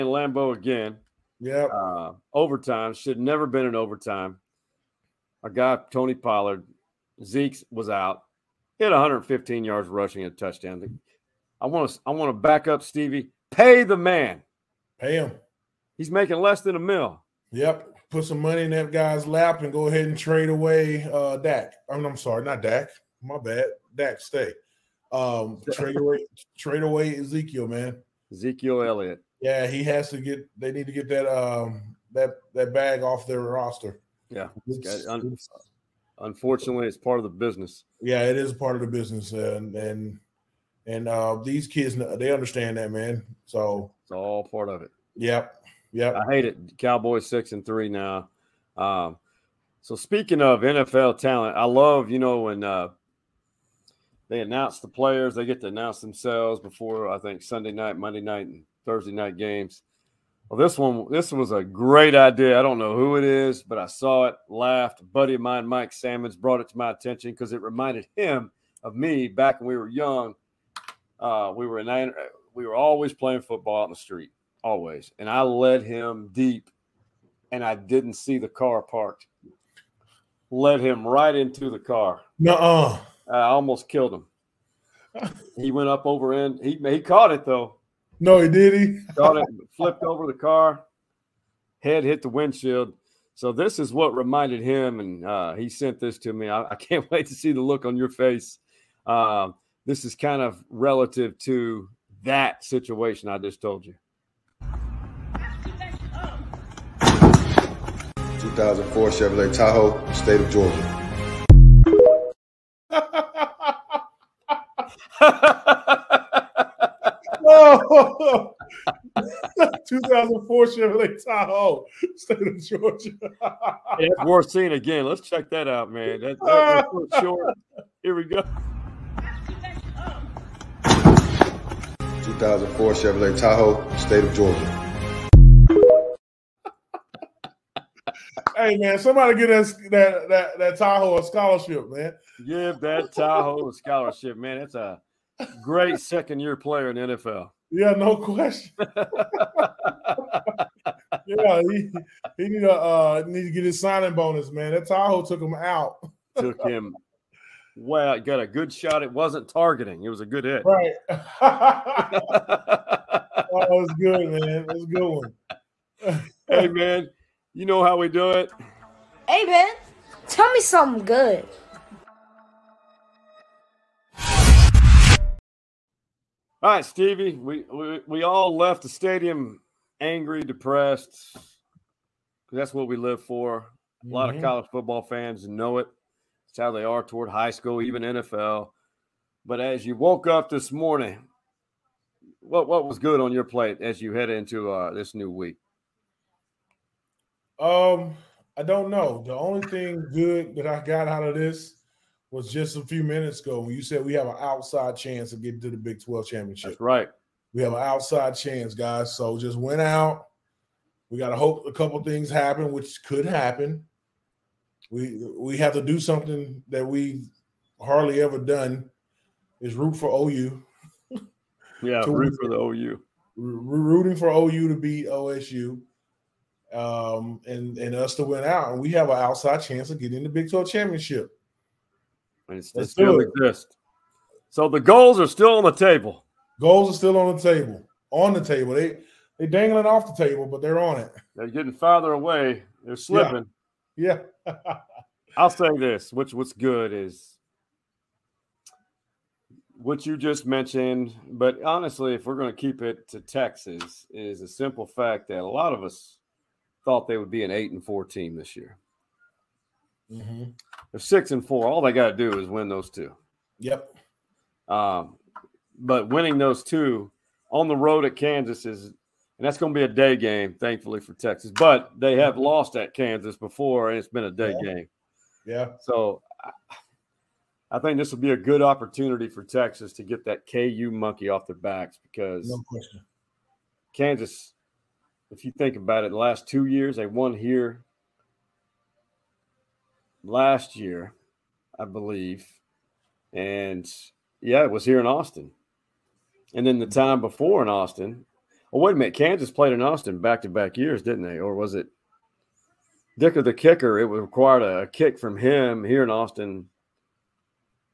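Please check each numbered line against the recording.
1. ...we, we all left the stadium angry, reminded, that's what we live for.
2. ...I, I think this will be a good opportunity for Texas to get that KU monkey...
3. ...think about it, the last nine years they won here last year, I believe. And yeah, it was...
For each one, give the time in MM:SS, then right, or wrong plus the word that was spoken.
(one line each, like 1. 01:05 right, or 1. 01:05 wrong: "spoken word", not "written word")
1. 02:57 wrong: "depressed", not "reminded"
2. 04:36 right
3. 04:45 wrong: "two", not "nine".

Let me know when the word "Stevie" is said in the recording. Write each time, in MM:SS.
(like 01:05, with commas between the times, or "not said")
00:12, 02:56.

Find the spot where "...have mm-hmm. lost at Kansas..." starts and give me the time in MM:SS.
04:32.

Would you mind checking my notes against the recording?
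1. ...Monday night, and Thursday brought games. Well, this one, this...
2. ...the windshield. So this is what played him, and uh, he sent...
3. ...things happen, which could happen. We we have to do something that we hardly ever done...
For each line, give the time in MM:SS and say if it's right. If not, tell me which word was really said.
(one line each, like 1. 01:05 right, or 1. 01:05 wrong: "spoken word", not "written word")
1. 00:57 wrong: "night", not "brought"
2. 01:32 wrong: "reminded", not "played"
3. 03:32 right.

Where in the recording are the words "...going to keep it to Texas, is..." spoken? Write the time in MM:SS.
04:12.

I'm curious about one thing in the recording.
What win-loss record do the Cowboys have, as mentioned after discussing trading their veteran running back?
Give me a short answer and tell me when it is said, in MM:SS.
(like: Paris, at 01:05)
six and three, at 00:47.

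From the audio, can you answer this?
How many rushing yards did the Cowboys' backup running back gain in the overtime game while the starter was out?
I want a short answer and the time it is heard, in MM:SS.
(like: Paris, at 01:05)
115, at 00:08.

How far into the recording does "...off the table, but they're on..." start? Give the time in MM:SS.
03:59.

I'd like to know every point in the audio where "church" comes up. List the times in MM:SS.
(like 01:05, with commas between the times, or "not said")
not said.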